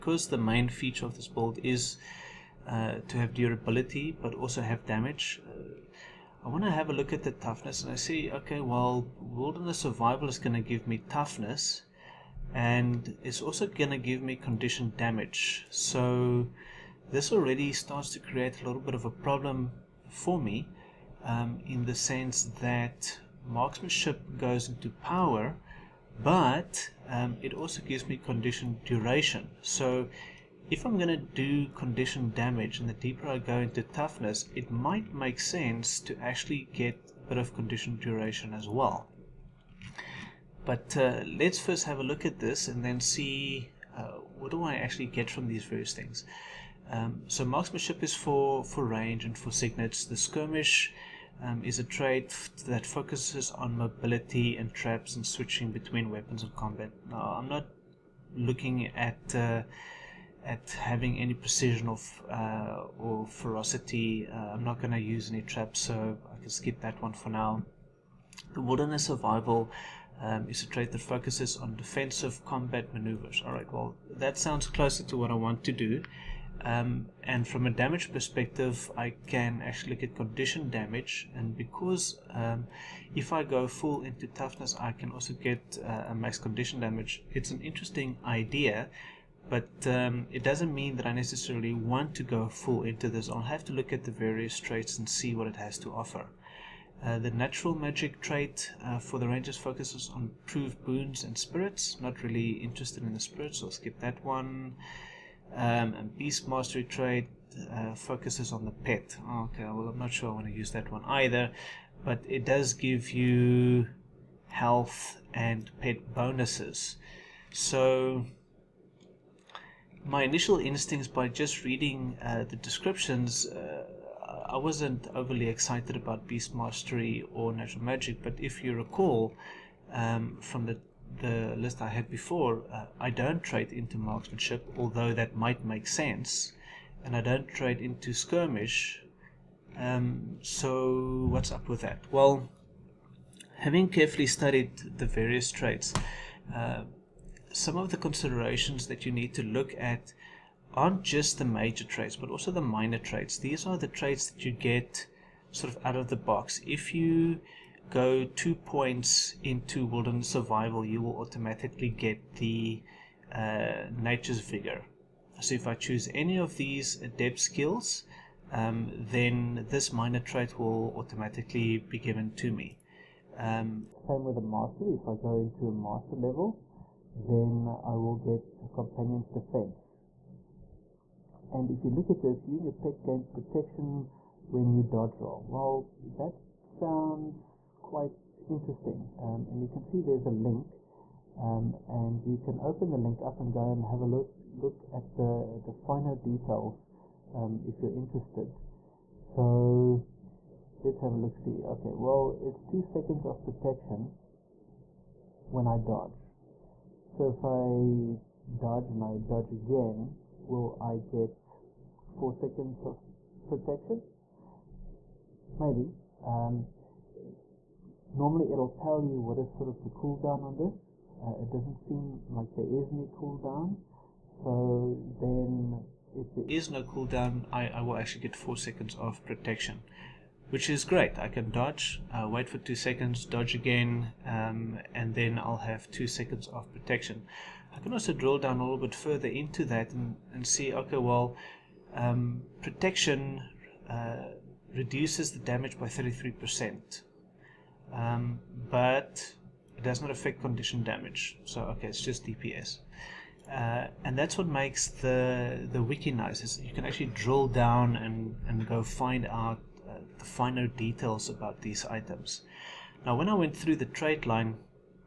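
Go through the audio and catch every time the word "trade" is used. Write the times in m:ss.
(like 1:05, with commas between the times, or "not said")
2:13, 2:17, 4:23.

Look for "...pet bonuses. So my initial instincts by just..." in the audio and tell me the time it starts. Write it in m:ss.
1:55.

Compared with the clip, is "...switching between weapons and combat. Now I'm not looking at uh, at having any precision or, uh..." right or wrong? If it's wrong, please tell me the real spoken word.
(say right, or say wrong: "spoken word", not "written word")
right.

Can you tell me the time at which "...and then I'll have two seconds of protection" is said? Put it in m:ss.
3:54.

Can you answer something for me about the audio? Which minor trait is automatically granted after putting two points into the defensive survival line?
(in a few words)
Nature's Vigor.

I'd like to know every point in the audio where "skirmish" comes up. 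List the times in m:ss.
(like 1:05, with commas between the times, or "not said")
0:50, 2:18.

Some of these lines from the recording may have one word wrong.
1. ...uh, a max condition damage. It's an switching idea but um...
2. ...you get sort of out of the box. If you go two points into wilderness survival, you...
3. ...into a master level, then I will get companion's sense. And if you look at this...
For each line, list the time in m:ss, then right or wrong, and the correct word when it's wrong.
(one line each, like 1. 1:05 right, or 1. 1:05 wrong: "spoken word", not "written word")
1. 1:25 wrong: "interesting", not "switching"
2. 2:34 right
3. 2:55 wrong: "defense", not "sense".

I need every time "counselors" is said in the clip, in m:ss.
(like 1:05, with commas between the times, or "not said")
not said.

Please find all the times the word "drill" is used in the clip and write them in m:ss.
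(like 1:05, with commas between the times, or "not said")
3:58, 4:17.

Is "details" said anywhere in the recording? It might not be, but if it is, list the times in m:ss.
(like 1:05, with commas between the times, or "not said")
3:16, 4:20.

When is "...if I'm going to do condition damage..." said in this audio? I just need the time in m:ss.
0:30.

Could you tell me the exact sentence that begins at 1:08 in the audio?
The wilderness survival um, is a trait that focuses on defensive combat maneuvers.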